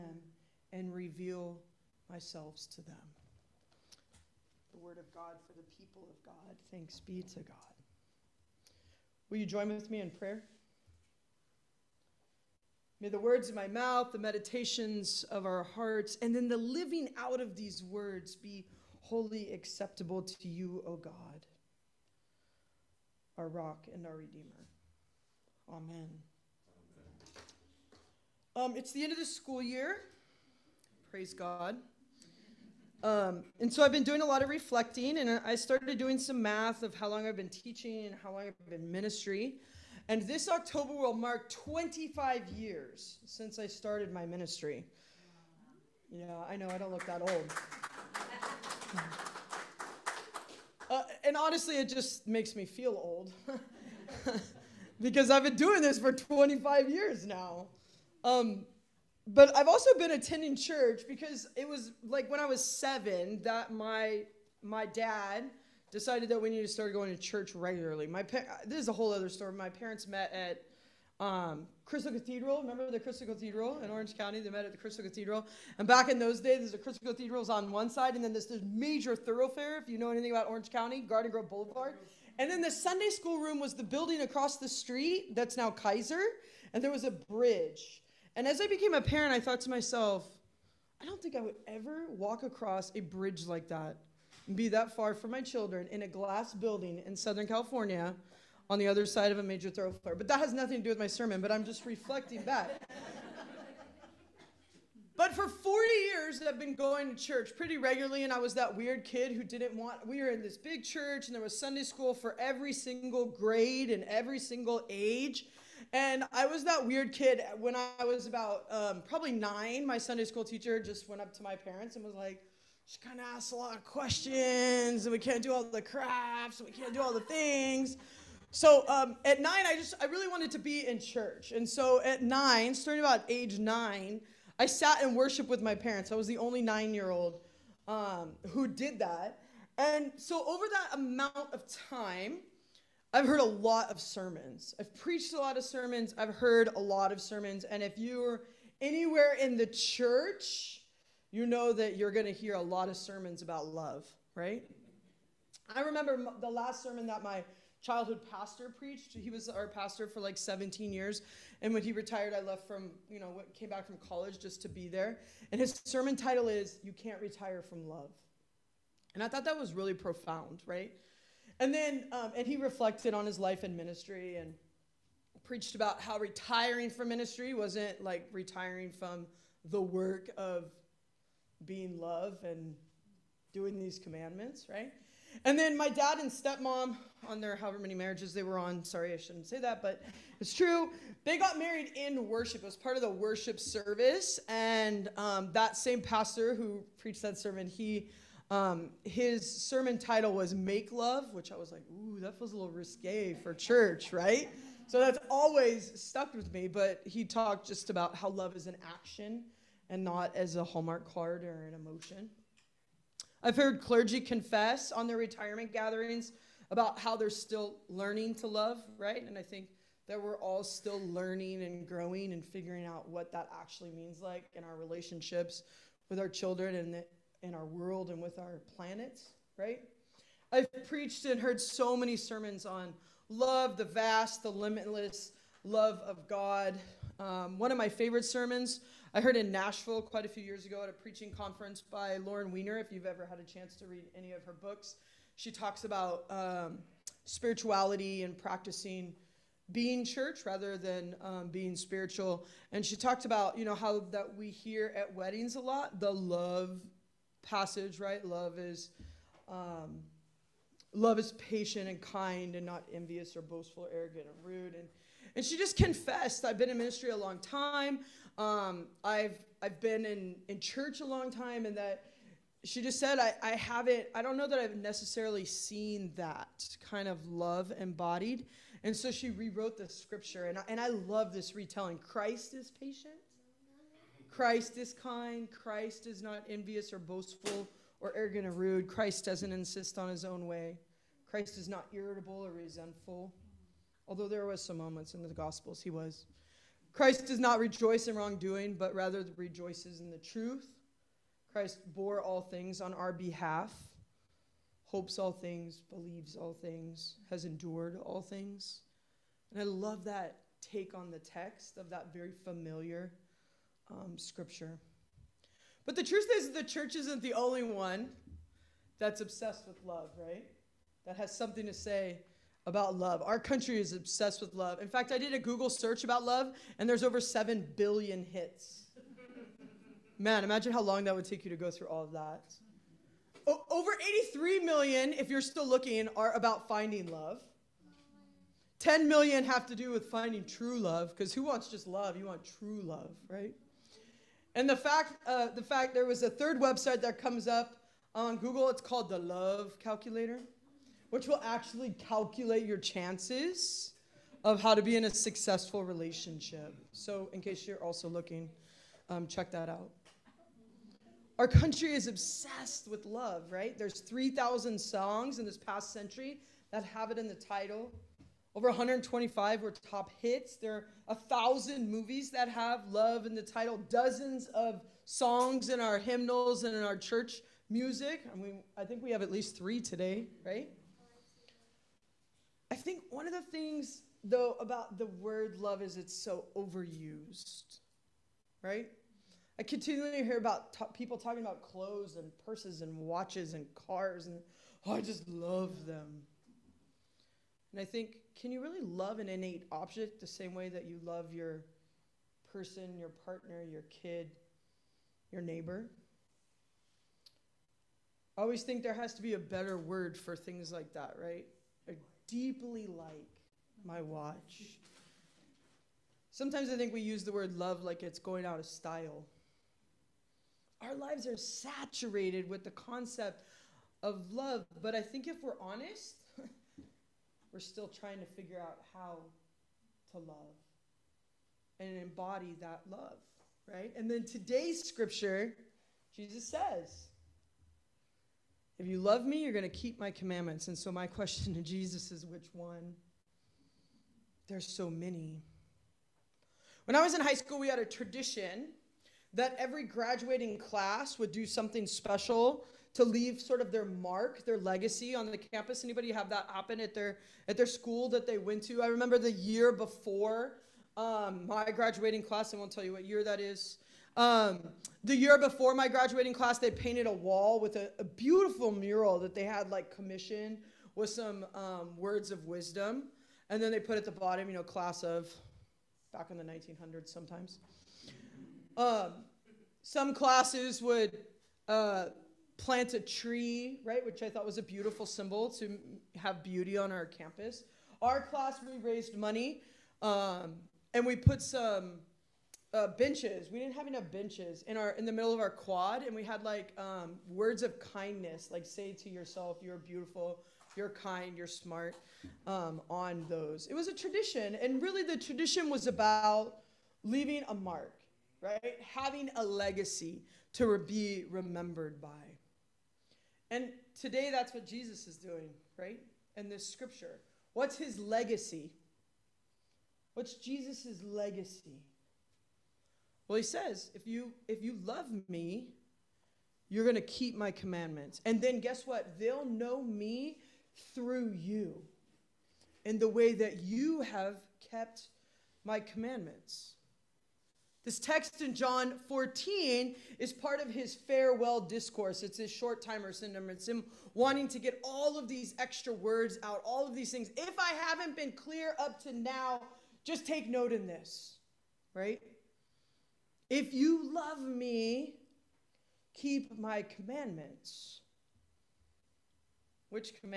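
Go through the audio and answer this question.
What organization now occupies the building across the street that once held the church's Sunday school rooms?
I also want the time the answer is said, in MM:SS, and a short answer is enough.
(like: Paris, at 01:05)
Kaiser, at 01:25.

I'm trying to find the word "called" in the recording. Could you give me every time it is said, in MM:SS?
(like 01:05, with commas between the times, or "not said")
05:48.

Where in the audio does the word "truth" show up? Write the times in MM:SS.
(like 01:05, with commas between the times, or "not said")
05:00, 05:16.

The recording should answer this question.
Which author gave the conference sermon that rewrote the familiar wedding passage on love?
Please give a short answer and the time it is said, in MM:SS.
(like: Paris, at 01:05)
Lauren Winner, at 04:02.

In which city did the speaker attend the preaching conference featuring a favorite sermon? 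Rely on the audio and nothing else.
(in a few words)
Nashville.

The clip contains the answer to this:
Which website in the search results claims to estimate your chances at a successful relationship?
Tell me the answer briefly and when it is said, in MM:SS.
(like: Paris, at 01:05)
Love Calculator, at 05:49.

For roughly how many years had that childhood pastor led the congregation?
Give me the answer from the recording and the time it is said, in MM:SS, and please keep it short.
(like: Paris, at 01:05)
17, at 02:40.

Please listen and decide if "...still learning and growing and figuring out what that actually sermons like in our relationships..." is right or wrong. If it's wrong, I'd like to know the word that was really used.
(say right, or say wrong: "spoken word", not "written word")
wrong: "means", not "sermons".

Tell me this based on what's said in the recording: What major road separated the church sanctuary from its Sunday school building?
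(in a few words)
Garden Grove Boulevard.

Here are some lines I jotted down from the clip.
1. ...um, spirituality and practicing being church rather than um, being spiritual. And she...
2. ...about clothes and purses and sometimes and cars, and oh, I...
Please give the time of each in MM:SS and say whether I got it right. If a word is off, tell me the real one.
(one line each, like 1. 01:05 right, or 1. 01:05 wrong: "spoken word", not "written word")
1. 04:06 right
2. 06:31 wrong: "watches", not "sometimes".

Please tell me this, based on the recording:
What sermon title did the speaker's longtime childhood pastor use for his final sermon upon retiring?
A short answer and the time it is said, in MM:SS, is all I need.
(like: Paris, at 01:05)
You Can't Retire from Love, at 02:46.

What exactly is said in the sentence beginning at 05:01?
Christ bore all things on our behalf, hopes all things, believes all things, has endured all things.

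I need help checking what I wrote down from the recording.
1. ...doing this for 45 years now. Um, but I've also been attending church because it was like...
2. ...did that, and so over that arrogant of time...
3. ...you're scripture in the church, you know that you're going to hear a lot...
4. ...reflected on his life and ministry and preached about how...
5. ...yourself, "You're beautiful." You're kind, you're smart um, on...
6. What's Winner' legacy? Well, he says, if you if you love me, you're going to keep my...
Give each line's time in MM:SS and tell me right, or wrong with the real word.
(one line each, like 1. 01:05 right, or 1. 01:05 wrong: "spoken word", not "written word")
1. 00:55 wrong: "25", not "45"
2. 02:18 wrong: "amount", not "arrogant"
3. 02:27 wrong: "anywhere", not "scripture"
4. 02:52 right
5. 08:19 right
6. 08:40 wrong: "Jesus", not "Winner".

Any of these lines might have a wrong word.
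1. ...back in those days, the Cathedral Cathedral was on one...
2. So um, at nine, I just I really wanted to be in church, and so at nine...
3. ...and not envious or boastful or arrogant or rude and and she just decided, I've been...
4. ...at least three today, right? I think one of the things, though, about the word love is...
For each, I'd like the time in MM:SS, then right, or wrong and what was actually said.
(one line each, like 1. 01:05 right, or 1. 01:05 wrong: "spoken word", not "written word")
1. 01:15 wrong: "Crystal", not "Cathedral"
2. 02:08 right
3. 04:22 wrong: "confessed", not "decided"
4. 06:19 right.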